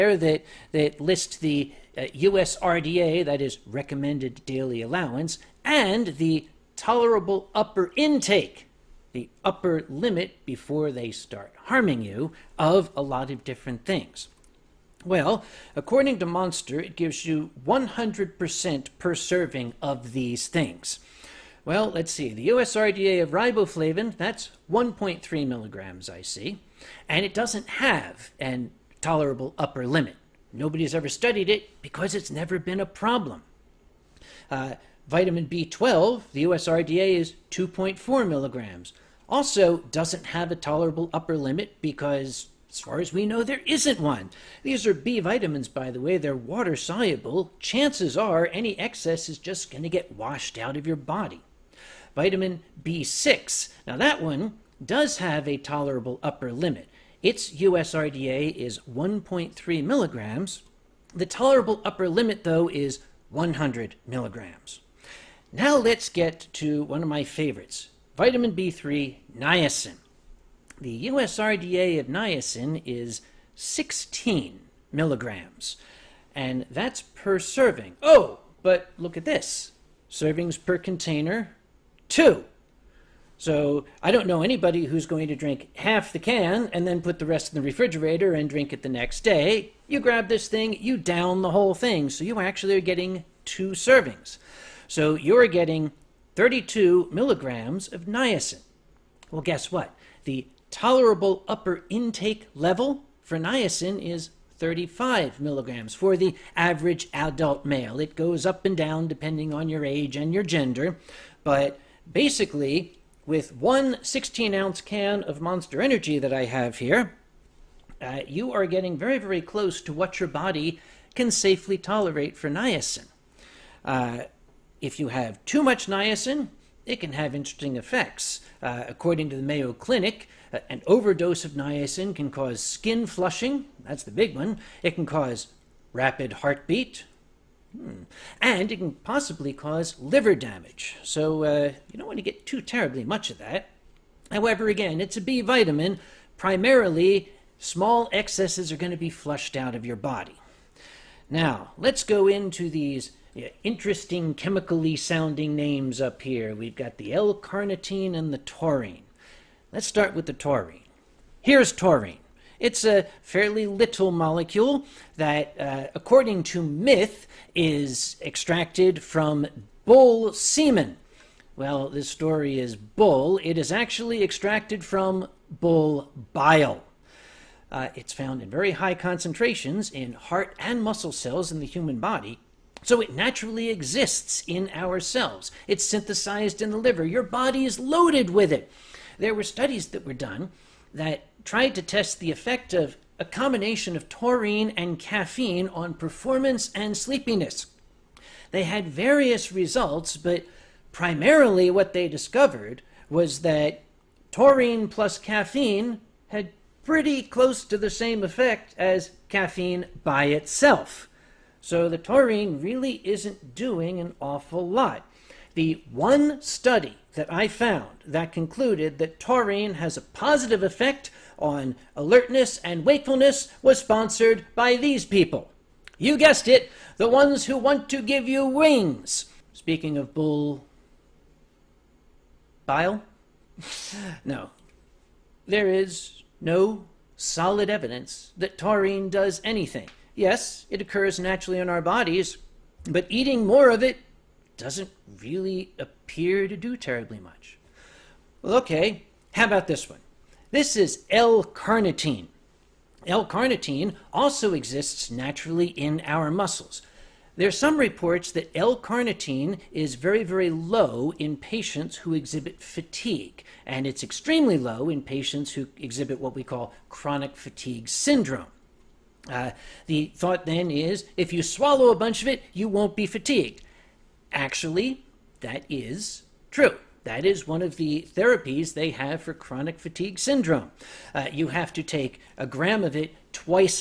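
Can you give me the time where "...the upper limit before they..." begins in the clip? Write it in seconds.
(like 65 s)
9 s.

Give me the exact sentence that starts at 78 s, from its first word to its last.
Oh, but look at this servings per container, two.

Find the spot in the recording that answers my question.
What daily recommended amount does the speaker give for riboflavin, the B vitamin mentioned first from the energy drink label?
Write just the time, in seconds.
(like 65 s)
24 s.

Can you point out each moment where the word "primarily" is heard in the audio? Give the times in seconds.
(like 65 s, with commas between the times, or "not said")
146 s, 200 s.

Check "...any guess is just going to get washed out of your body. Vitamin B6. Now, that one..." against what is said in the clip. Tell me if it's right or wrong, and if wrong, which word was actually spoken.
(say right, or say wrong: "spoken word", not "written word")
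wrong: "excess", not "guess".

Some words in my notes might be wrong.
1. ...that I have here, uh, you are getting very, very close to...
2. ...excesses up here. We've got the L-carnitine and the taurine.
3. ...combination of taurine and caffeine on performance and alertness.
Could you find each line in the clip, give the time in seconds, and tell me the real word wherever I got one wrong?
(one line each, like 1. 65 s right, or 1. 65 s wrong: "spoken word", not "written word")
1. 116 s right
2. 155 s wrong: "names", not "excesses"
3. 193 s wrong: "sleepiness", not "alertness".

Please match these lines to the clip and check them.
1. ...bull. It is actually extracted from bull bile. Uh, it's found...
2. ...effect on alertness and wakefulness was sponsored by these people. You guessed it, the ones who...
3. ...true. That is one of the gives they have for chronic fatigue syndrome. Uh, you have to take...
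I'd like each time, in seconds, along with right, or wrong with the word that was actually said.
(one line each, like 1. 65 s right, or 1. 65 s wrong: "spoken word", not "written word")
1. 172 s right
2. 220 s right
3. 276 s wrong: "therapies", not "gives".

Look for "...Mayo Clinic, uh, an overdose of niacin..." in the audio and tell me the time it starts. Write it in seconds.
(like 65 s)
129 s.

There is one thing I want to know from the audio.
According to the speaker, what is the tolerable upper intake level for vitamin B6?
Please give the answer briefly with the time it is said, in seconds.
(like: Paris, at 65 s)
100 milligrams, at 63 s.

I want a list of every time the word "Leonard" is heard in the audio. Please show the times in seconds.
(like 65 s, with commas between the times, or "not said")
not said.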